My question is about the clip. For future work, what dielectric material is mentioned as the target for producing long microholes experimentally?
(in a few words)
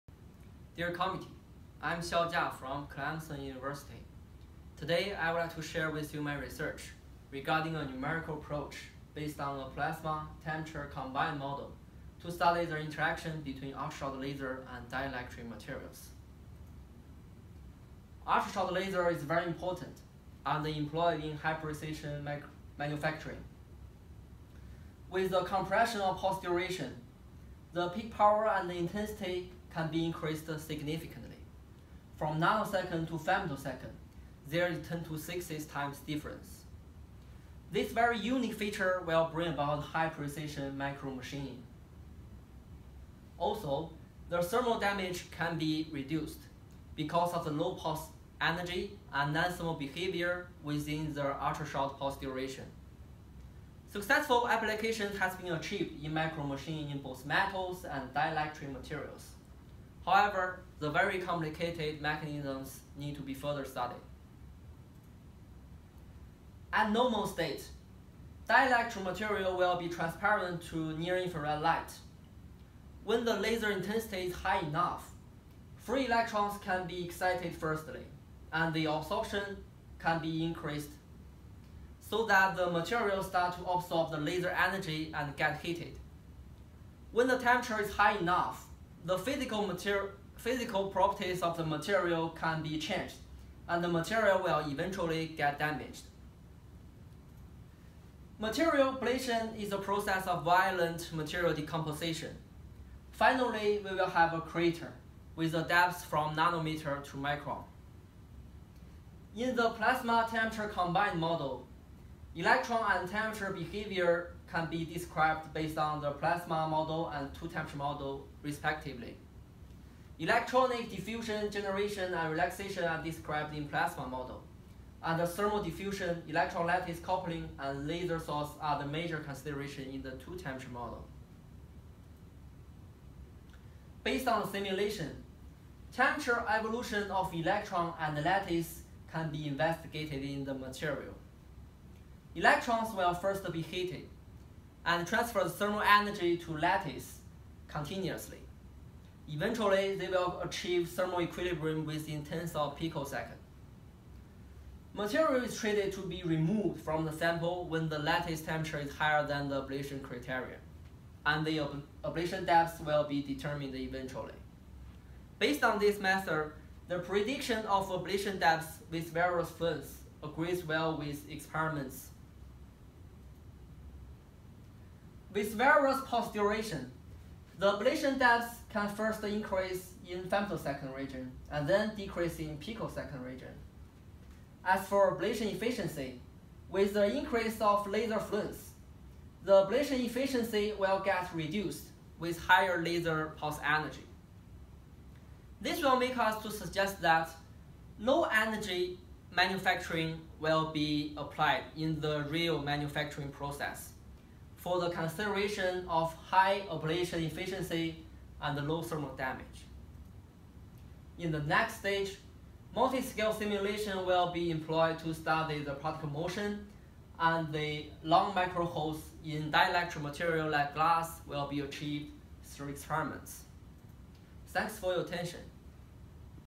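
glass.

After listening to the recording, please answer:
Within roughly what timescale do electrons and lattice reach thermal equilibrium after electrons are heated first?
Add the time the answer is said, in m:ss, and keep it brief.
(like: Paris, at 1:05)
tens of picoseconds, at 2:32.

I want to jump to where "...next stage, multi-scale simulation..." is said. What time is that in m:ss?
3:31.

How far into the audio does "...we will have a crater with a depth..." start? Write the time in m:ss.
1:43.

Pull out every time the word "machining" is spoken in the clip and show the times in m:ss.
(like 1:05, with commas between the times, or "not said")
0:41, 0:56.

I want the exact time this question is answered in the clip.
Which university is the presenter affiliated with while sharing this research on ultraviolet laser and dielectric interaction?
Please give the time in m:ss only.
0:02.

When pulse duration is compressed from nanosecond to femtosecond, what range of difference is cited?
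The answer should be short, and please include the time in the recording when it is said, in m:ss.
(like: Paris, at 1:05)
10 to 60 times, at 0:34.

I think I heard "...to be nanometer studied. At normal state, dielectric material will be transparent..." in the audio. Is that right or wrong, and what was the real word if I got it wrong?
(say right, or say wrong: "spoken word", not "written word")
wrong: "further", not "nanometer".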